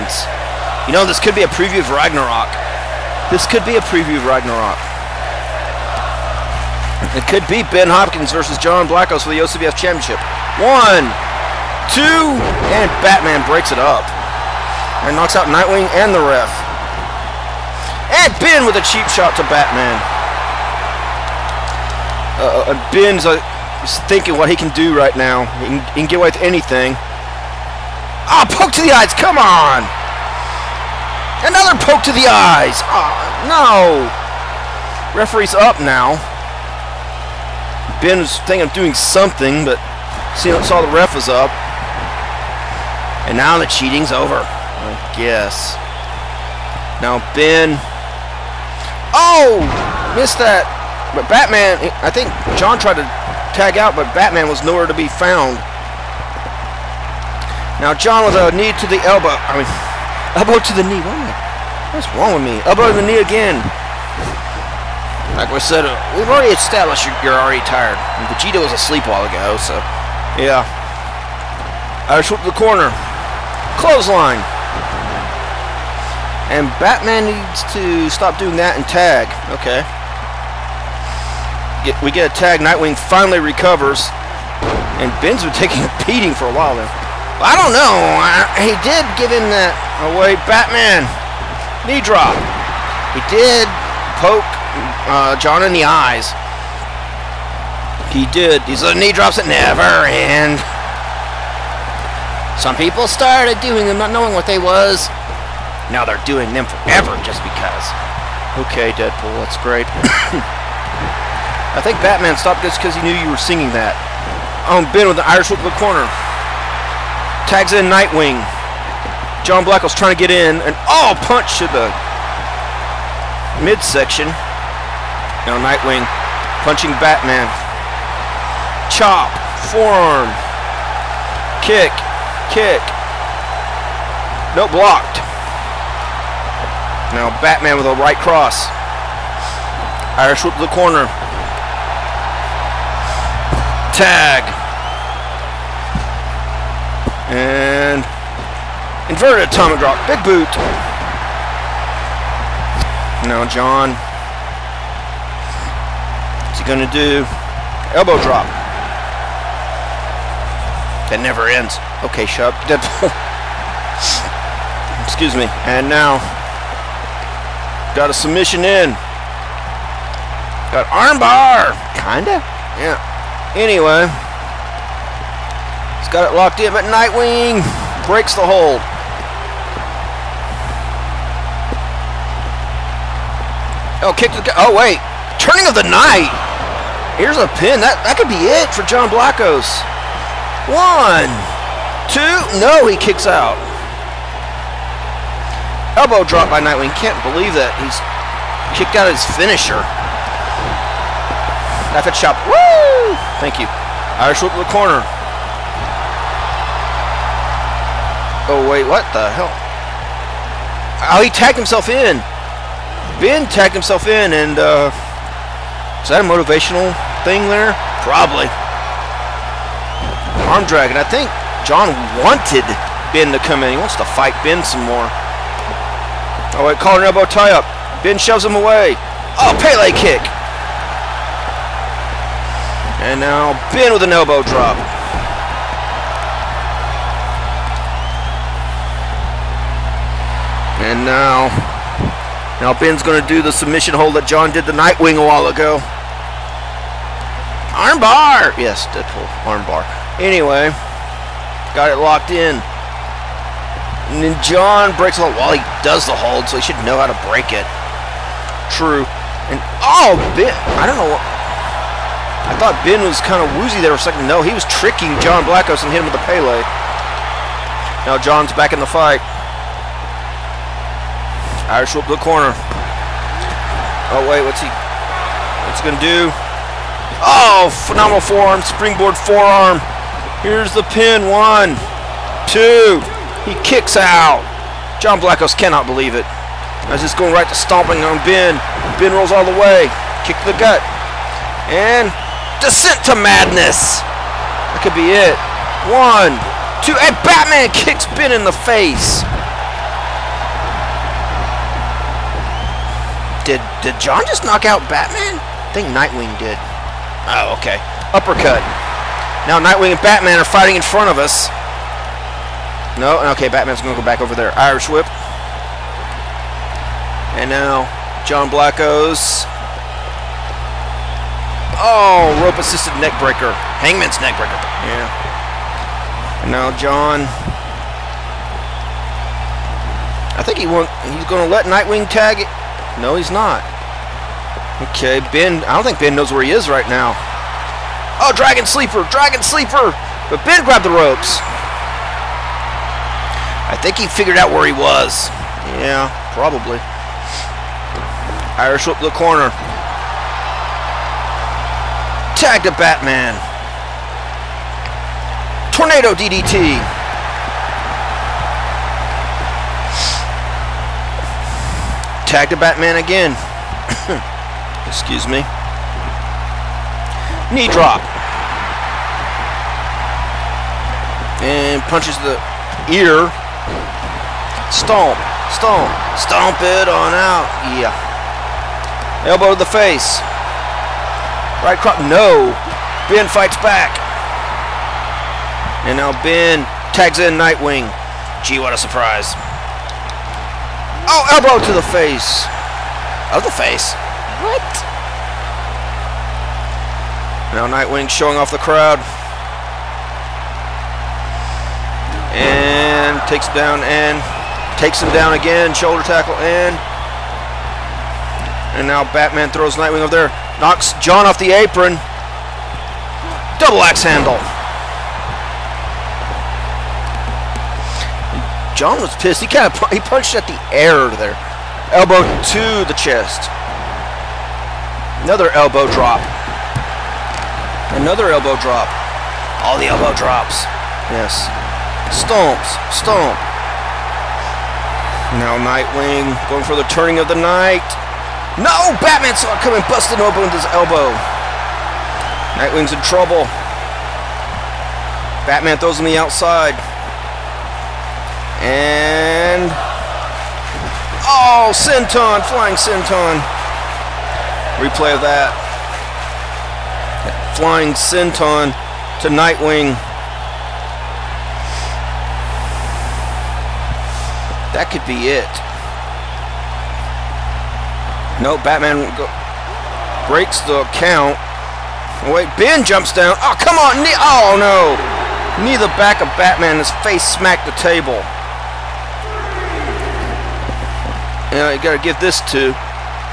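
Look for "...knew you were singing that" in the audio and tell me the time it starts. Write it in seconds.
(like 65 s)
113 s.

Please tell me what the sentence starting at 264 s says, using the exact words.
No, he was tricking John Blackos and hit him with a Pele.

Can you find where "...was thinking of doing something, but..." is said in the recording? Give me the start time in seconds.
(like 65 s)
38 s.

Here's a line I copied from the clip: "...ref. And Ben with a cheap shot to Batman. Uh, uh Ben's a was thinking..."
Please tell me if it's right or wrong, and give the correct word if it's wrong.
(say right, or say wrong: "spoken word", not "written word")
right.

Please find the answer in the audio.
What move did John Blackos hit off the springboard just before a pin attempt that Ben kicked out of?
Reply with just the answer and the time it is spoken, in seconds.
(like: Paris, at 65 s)
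phenomenal forearm, at 277 s.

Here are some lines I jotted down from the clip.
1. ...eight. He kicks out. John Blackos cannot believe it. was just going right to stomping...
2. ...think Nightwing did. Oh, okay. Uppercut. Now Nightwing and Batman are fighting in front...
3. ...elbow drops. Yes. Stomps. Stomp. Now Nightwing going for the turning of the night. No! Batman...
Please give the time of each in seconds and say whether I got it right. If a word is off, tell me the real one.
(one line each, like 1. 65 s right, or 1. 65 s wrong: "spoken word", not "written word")
1. 282 s wrong: "two", not "eight"
2. 305 s right
3. 429 s right.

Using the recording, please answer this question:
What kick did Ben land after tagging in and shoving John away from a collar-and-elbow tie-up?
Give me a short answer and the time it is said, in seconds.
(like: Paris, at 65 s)
Pele kick, at 229 s.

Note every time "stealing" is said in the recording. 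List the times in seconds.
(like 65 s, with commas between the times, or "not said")
not said.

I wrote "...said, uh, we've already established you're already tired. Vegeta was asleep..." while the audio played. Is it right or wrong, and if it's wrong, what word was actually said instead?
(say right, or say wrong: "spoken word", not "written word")
right.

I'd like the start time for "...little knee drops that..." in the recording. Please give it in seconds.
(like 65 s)
98 s.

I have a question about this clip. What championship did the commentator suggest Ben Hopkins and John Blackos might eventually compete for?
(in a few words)
OCBF Championship.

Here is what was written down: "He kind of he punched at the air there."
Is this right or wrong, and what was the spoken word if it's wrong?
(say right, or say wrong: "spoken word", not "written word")
right.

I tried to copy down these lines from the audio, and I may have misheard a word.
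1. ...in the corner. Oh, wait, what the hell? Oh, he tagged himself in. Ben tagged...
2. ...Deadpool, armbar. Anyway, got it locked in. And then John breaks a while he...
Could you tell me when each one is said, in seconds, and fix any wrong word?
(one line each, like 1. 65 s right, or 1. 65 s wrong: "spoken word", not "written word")
1. 204 s right
2. 248 s right.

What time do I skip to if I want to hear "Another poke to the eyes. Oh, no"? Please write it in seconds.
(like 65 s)
31 s.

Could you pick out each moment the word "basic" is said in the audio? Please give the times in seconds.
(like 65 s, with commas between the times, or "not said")
not said.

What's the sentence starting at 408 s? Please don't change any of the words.
And now Batman throws Nightwing over there.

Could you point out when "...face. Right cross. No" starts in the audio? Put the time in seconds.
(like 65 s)
379 s.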